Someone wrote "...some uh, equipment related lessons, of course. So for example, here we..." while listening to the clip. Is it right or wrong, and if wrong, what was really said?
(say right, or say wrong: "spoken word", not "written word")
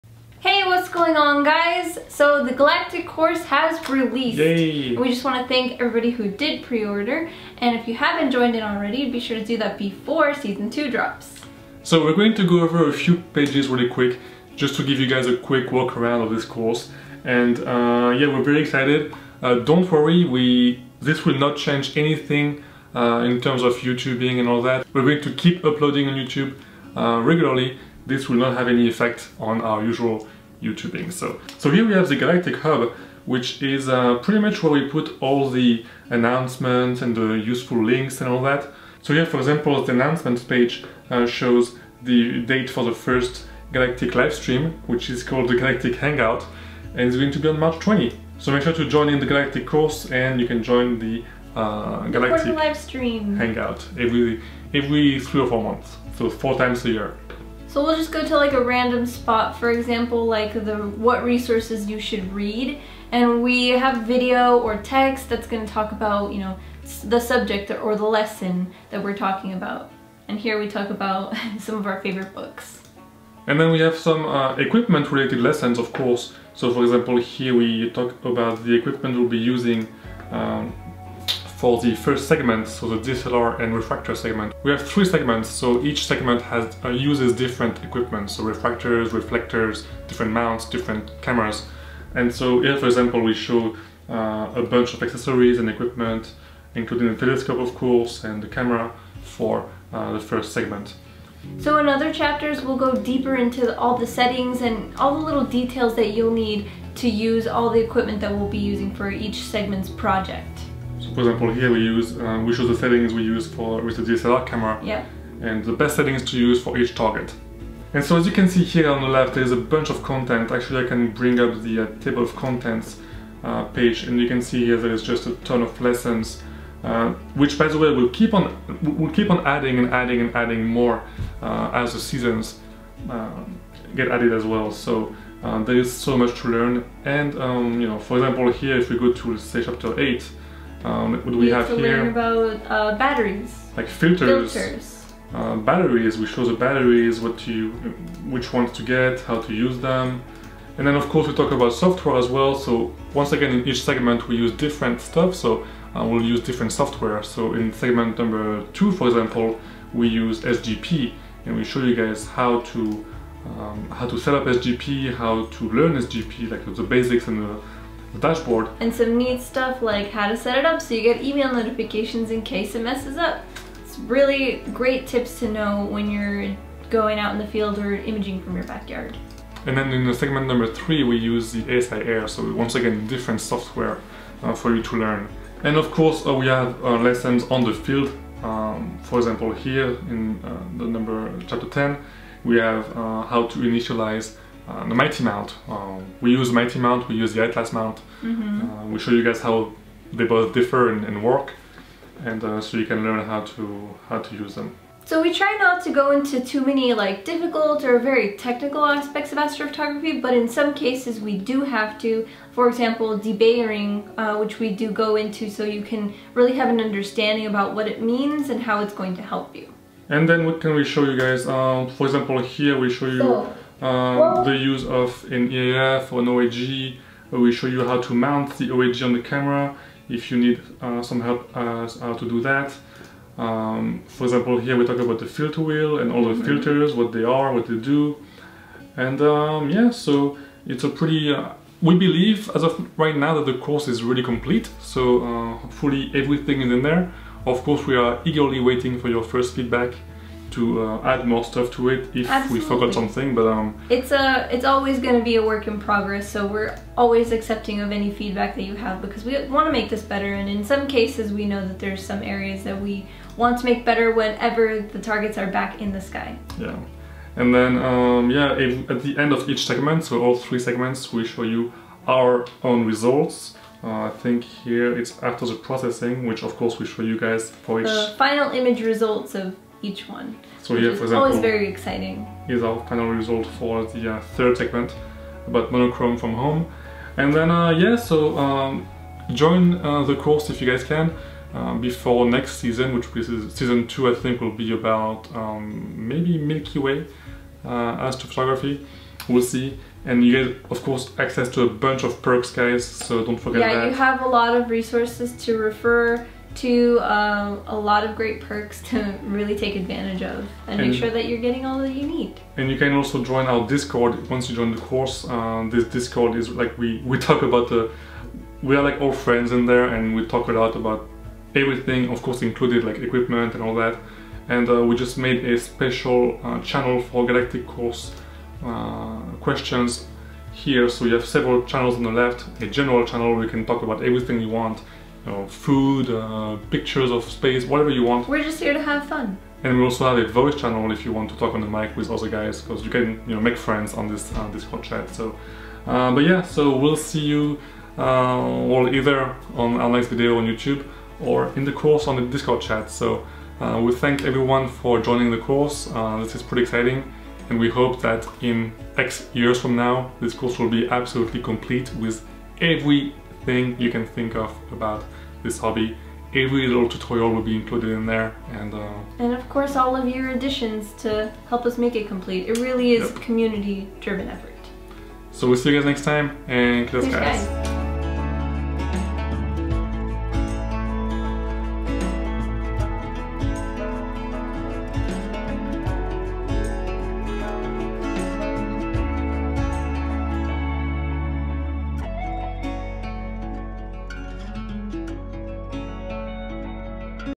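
right.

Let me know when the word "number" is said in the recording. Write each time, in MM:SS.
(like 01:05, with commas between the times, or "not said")
02:38, 03:00, 03:10.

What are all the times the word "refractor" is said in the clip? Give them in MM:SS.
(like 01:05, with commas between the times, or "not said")
01:23, 01:28.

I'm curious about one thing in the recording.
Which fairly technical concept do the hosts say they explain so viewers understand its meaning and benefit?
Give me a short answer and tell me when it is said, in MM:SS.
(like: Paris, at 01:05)
Debayering, at 03:33.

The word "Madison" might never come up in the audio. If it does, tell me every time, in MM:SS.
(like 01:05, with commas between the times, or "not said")
not said.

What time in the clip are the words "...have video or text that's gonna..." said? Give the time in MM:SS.
01:03.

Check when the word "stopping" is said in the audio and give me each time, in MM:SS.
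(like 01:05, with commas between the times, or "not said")
not said.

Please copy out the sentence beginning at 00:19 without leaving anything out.
Uh, don't worry, we this will not change anything uh, in terms of YouTubing and all that.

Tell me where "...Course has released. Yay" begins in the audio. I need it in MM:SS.
00:03.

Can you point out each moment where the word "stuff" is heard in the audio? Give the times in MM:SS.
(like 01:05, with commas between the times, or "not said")
02:35, 02:49, 04:11.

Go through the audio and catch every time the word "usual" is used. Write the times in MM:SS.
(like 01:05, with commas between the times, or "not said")
00:29.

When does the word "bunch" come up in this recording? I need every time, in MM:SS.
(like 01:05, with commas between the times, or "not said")
01:34, 01:59, 05:01.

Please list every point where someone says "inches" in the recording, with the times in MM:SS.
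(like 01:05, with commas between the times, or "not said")
not said.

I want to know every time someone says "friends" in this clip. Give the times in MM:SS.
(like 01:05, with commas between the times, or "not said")
05:19, 05:43.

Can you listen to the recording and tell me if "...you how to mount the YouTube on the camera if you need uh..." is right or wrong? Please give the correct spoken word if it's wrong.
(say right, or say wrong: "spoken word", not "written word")
wrong: "OAG", not "YouTube".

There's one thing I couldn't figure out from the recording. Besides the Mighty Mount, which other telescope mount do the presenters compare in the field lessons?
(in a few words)
Atlas Mount.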